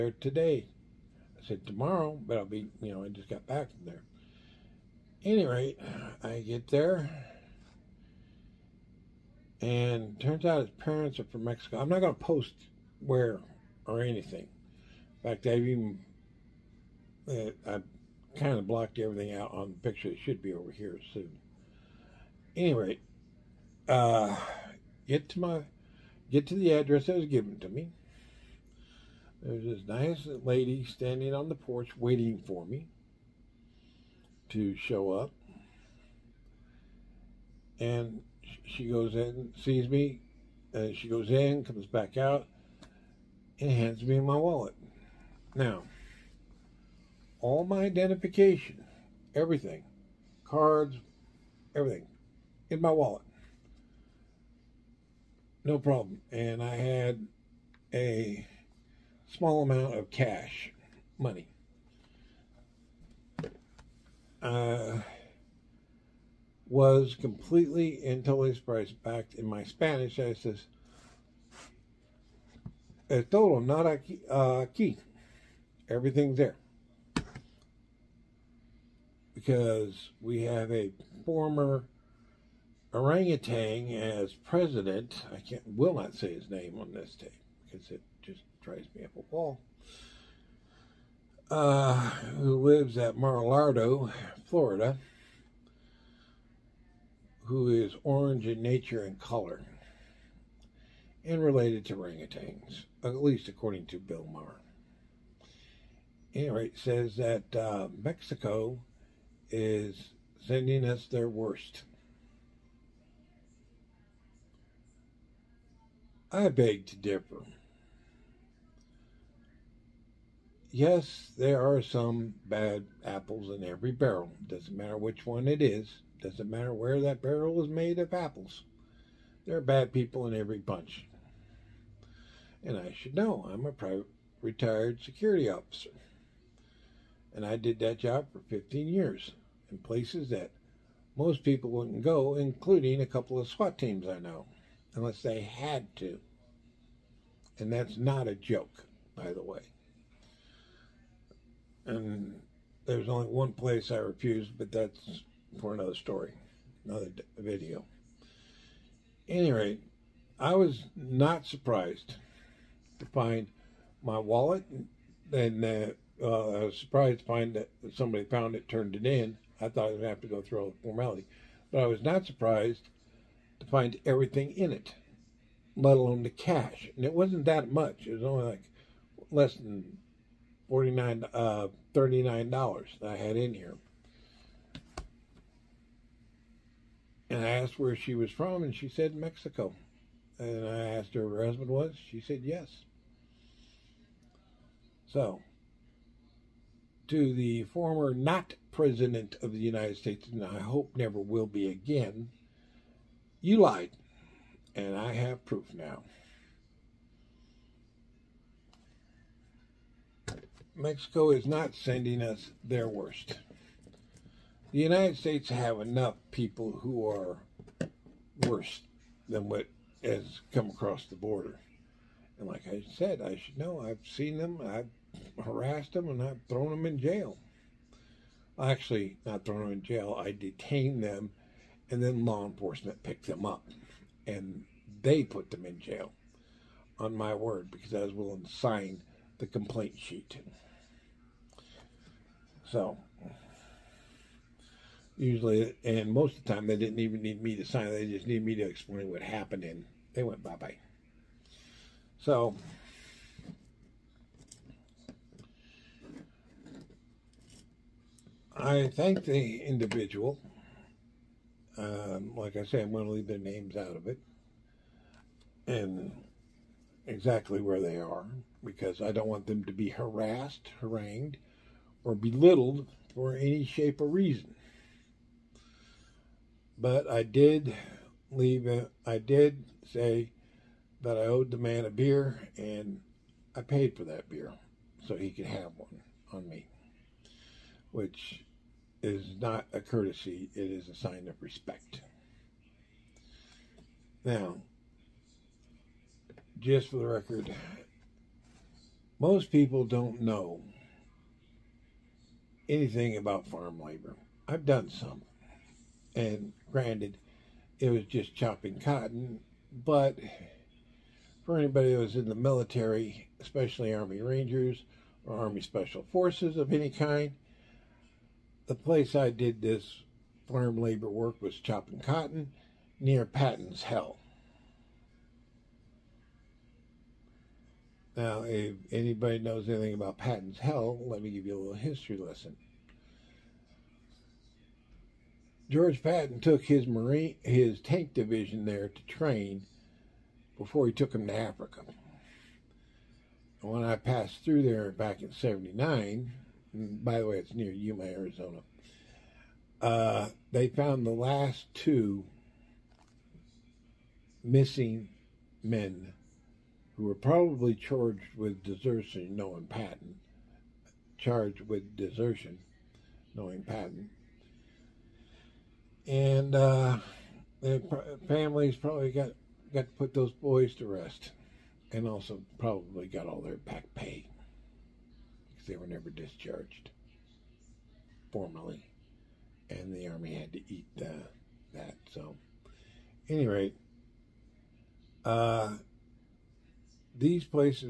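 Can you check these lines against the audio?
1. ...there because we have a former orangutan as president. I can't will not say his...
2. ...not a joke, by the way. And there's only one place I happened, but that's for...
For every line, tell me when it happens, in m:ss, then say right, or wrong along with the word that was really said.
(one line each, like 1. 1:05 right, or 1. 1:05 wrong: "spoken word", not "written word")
1. 1:16 right
2. 2:27 wrong: "refused", not "happened".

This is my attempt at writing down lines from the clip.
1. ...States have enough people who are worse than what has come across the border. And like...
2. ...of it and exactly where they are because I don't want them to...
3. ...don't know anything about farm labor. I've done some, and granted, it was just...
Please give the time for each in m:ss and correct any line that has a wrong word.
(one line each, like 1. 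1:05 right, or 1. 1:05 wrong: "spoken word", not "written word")
1. 3:35 right
2. 4:23 right
3. 4:59 right.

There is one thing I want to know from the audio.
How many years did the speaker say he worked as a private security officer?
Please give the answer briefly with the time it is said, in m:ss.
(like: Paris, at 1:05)
15, at 2:18.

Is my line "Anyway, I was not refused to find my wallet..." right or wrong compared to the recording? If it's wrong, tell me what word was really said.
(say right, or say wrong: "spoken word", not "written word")
wrong: "surprised", not "refused".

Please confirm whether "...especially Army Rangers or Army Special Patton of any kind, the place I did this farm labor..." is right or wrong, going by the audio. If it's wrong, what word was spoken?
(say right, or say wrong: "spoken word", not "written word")
wrong: "Forces", not "Patton".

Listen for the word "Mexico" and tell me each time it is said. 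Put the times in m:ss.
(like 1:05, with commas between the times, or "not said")
0:11, 1:47, 3:09, 3:30.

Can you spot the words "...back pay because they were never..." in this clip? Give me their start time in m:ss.
6:13.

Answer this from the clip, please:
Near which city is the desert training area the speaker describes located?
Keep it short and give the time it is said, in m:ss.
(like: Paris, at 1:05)
Yuma, Arizona, at 5:47.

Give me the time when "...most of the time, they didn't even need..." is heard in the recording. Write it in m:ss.
4:06.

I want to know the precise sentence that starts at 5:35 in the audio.
George Patton took his marine his tank division there to train before he took him to Africa.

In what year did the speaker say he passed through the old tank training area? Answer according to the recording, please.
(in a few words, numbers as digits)
1979.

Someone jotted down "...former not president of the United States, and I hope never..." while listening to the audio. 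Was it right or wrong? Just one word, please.
right.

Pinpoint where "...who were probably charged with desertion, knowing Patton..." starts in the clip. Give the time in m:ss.
5:56.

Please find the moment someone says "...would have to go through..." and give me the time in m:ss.
2:49.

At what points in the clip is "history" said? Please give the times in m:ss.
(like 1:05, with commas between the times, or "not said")
5:31.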